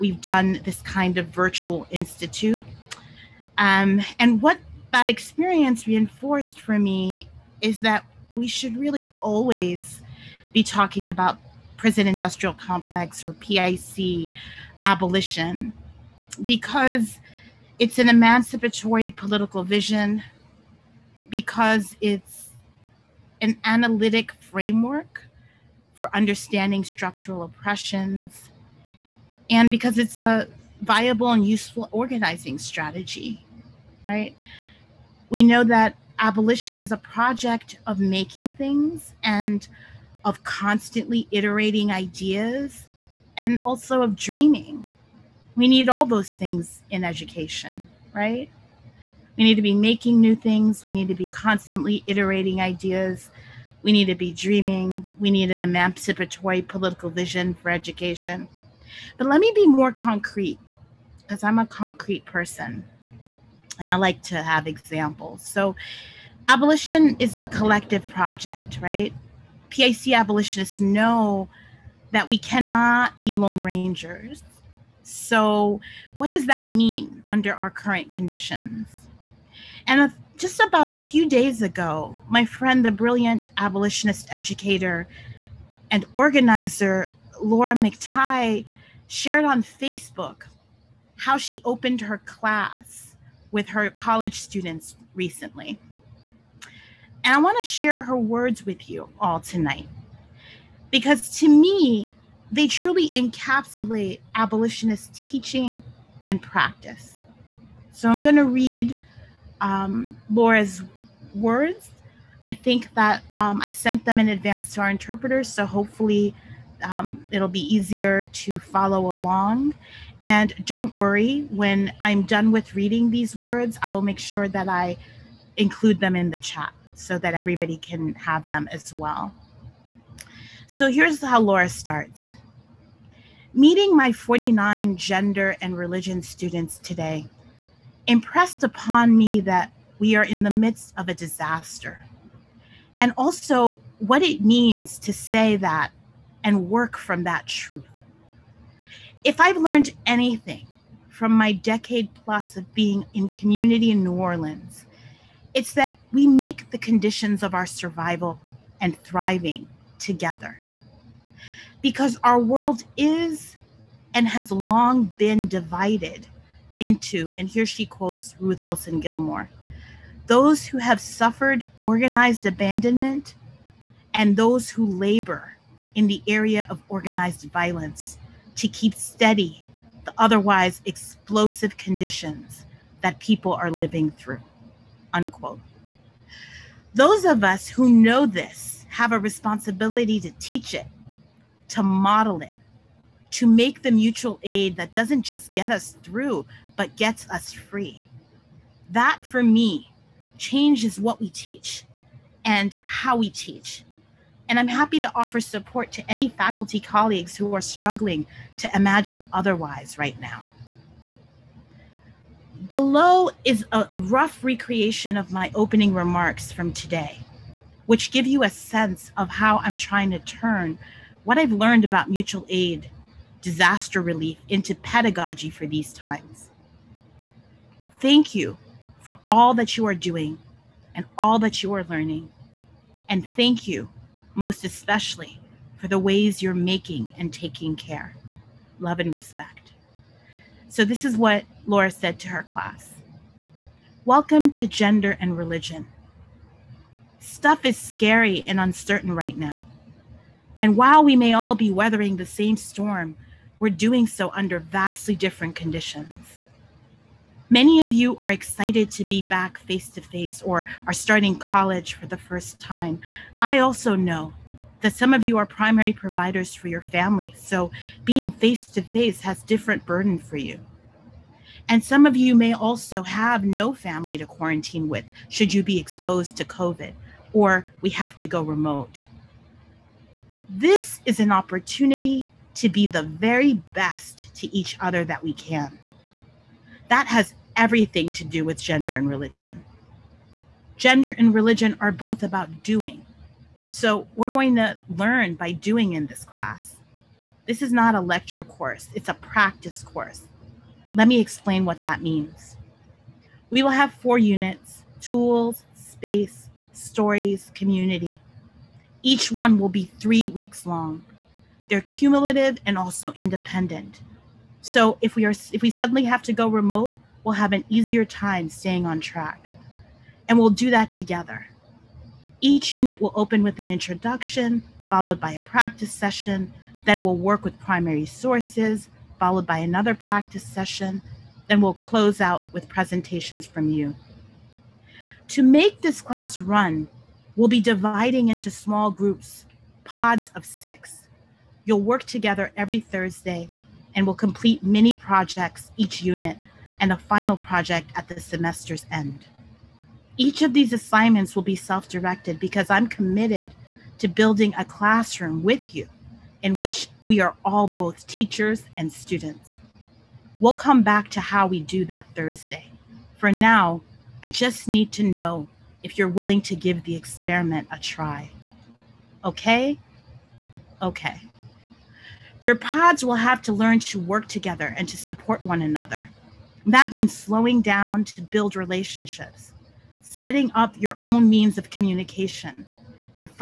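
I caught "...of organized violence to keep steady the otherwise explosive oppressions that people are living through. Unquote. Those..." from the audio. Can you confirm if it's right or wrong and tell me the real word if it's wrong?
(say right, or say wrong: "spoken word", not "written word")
wrong: "conditions", not "oppressions".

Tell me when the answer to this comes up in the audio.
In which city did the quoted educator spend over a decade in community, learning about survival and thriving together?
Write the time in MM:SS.
02:34.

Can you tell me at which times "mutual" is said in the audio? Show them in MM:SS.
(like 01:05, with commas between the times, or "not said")
03:13, 03:42.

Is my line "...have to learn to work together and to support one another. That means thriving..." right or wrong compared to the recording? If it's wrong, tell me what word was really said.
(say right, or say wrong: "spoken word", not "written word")
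wrong: "slowing", not "thriving".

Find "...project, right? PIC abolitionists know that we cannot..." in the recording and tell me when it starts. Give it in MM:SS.
01:08.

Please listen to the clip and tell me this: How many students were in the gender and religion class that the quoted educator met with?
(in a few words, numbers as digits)
49.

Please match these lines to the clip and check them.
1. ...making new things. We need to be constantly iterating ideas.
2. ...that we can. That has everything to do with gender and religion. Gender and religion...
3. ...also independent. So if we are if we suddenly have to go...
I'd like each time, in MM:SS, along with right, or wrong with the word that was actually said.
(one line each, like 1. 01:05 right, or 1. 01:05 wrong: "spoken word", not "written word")
1. 00:49 right
2. 04:45 right
3. 05:12 right.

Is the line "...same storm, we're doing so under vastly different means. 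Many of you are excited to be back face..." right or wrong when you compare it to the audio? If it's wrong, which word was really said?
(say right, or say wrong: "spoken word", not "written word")
wrong: "conditions", not "means".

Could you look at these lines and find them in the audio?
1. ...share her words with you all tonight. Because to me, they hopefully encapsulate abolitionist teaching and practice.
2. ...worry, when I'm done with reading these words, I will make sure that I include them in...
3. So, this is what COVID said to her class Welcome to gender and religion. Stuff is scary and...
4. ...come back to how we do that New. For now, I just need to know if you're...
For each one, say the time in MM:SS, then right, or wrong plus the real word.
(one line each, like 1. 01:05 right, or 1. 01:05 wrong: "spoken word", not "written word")
1. 01:37 wrong: "truly", not "hopefully"
2. 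02:00 right
3. 04:00 wrong: "Laura", not "COVID"
4. 06:00 wrong: "Thursday", not "New".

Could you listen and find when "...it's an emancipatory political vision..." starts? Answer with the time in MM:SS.
00:17.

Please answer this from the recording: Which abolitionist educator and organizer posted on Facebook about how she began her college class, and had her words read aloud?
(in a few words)
Laura McTighe.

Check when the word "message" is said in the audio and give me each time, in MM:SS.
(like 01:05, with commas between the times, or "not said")
not said.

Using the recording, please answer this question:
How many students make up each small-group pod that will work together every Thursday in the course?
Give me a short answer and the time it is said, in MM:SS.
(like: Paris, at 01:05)
6, at 05:40.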